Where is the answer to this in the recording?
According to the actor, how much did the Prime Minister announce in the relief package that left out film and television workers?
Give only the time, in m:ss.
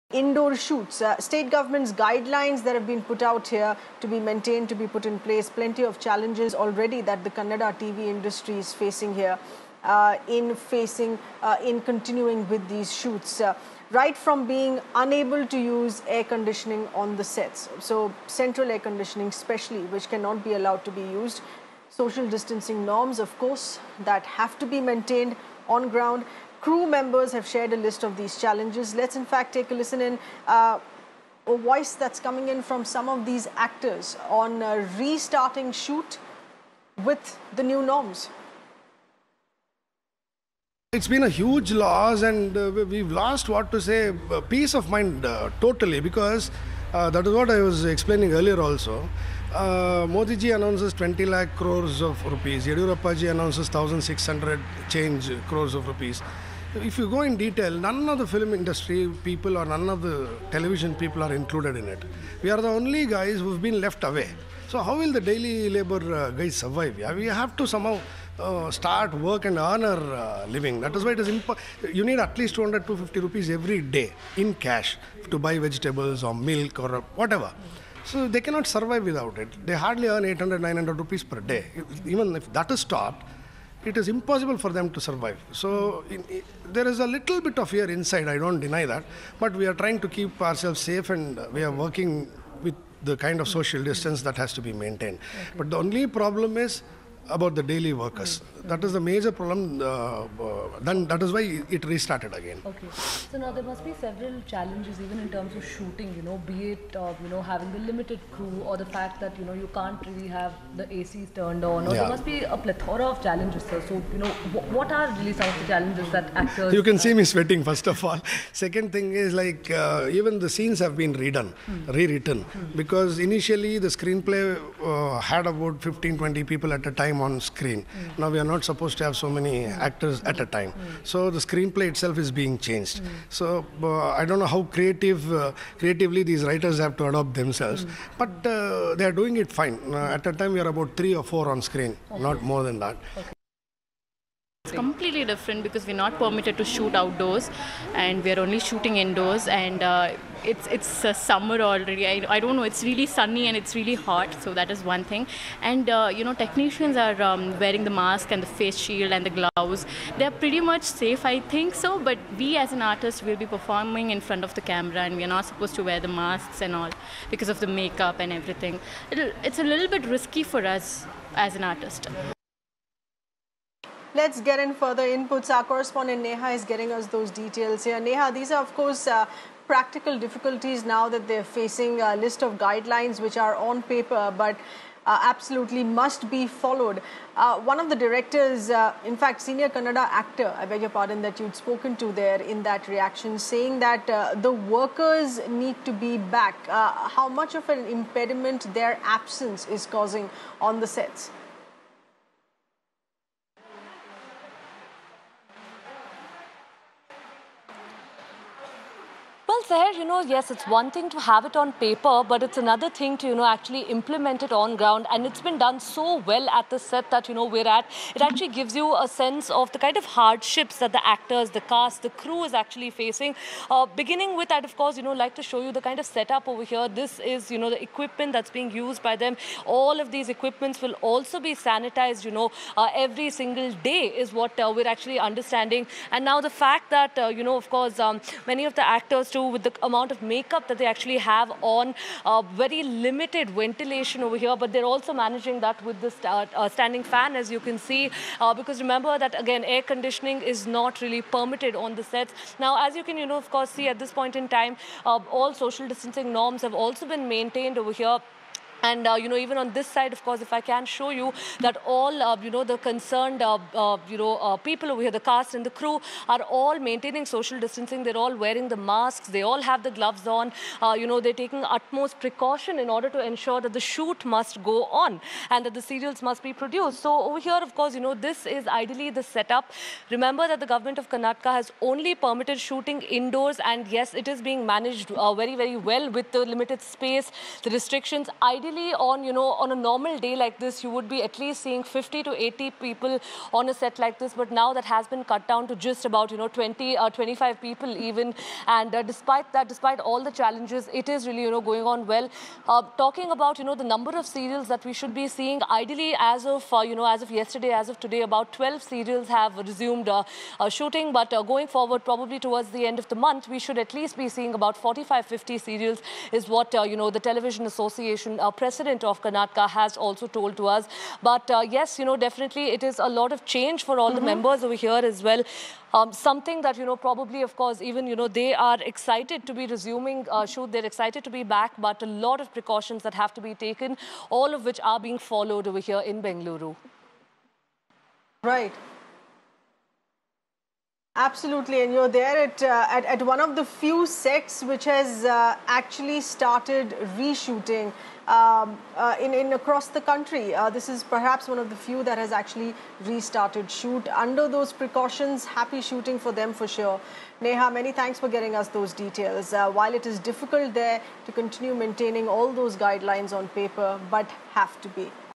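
0:50.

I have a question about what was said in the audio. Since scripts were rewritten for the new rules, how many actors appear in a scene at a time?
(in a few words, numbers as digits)
3 or 4.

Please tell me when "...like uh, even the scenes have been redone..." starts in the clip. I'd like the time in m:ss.
1:59.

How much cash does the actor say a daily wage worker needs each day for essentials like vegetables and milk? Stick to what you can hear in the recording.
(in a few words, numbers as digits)
200-250 rupees.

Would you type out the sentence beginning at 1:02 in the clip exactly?
We are the only guys who've been left away.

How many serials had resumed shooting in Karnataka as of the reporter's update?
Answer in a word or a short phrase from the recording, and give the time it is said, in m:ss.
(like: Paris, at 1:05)
12, at 5:08.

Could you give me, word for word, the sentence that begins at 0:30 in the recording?
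Uh, a voice that's coming in from some of these actors on restarting shoot with the new norms.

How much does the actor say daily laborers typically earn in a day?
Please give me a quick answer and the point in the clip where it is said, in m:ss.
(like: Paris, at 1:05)
800-900 rupees, at 1:20.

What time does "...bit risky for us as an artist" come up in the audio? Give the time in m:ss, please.
2:49.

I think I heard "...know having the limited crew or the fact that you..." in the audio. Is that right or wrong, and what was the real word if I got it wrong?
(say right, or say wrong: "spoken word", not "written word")
right.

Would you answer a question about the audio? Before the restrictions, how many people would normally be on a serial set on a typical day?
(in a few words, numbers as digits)
50 to 80.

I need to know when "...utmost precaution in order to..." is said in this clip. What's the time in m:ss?
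4:31.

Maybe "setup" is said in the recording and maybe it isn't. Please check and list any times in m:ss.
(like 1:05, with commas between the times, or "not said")
3:46, 4:39.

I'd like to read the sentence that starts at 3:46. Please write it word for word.
This is, you know, the equipment that's being used by them.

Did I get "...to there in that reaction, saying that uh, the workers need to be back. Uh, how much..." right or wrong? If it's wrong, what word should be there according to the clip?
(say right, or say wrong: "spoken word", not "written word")
right.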